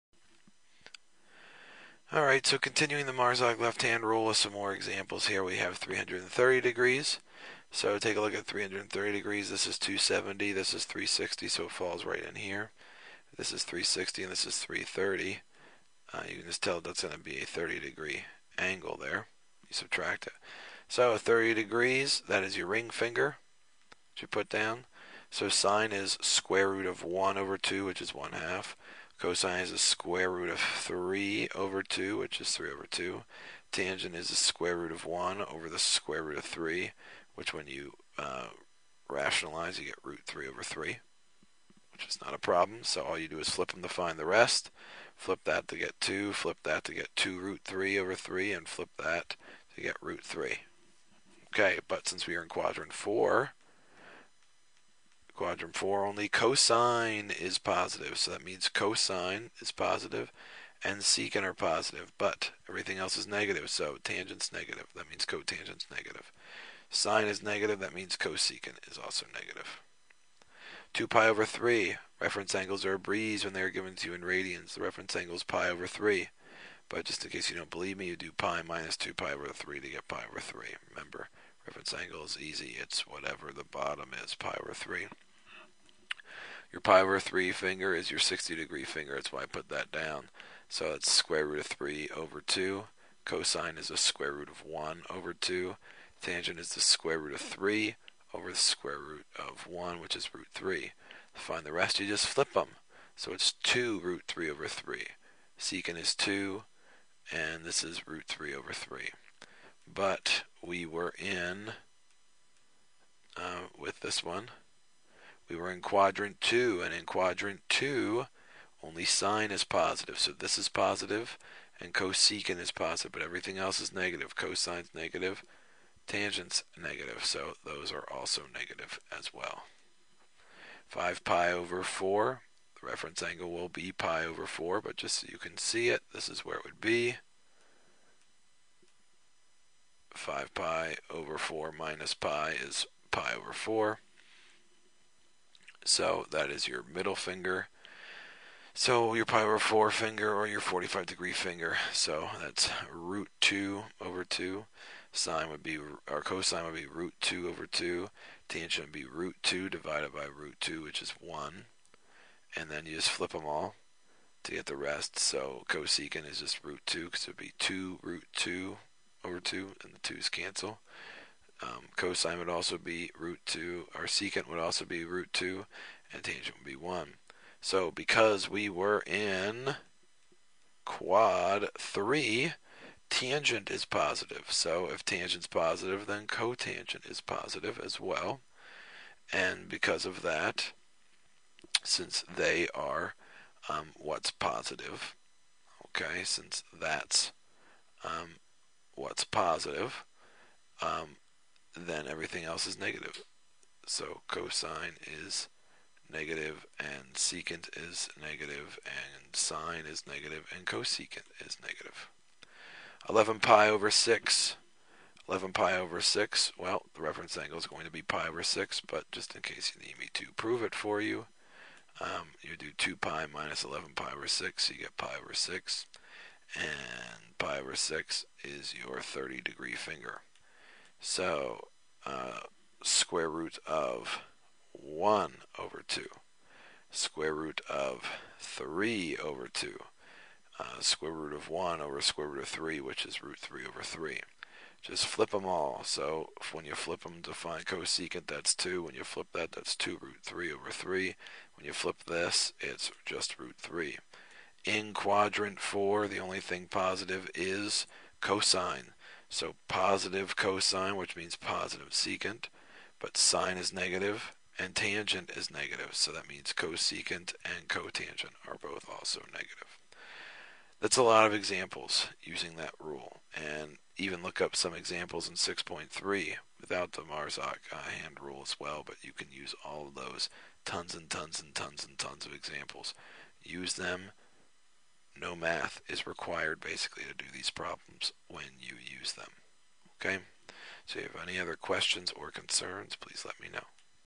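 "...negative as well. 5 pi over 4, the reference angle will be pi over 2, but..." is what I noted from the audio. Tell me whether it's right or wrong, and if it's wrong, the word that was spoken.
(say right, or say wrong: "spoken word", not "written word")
wrong: "4", not "2".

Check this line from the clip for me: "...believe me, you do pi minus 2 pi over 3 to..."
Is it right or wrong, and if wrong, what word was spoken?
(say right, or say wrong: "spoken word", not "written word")
right.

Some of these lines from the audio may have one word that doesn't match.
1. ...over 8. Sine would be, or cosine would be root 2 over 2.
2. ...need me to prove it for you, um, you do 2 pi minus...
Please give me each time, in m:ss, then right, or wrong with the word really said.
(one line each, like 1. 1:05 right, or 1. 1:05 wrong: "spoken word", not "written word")
1. 2:33 wrong: "2", not "8"
2. 3:39 right.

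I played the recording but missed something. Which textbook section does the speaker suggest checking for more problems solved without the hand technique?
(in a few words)
6.3.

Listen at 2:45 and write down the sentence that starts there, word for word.
So cosecant is just root 2 because it would be 2 root 2 over 2, and the 2's cancel.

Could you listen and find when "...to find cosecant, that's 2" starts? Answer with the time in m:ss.
4:07.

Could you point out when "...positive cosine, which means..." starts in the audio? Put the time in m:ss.
4:19.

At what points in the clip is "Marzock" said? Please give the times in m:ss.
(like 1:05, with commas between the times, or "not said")
0:03, 4:37.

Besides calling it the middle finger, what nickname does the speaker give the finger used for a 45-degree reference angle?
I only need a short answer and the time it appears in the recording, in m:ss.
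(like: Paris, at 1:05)
power finger, at 2:29.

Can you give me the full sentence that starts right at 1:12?
Reference angles are a breeze when they are given to you in radians.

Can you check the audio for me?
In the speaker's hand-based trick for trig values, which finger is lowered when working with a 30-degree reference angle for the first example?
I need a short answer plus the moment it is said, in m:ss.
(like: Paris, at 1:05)
ring finger, at 0:22.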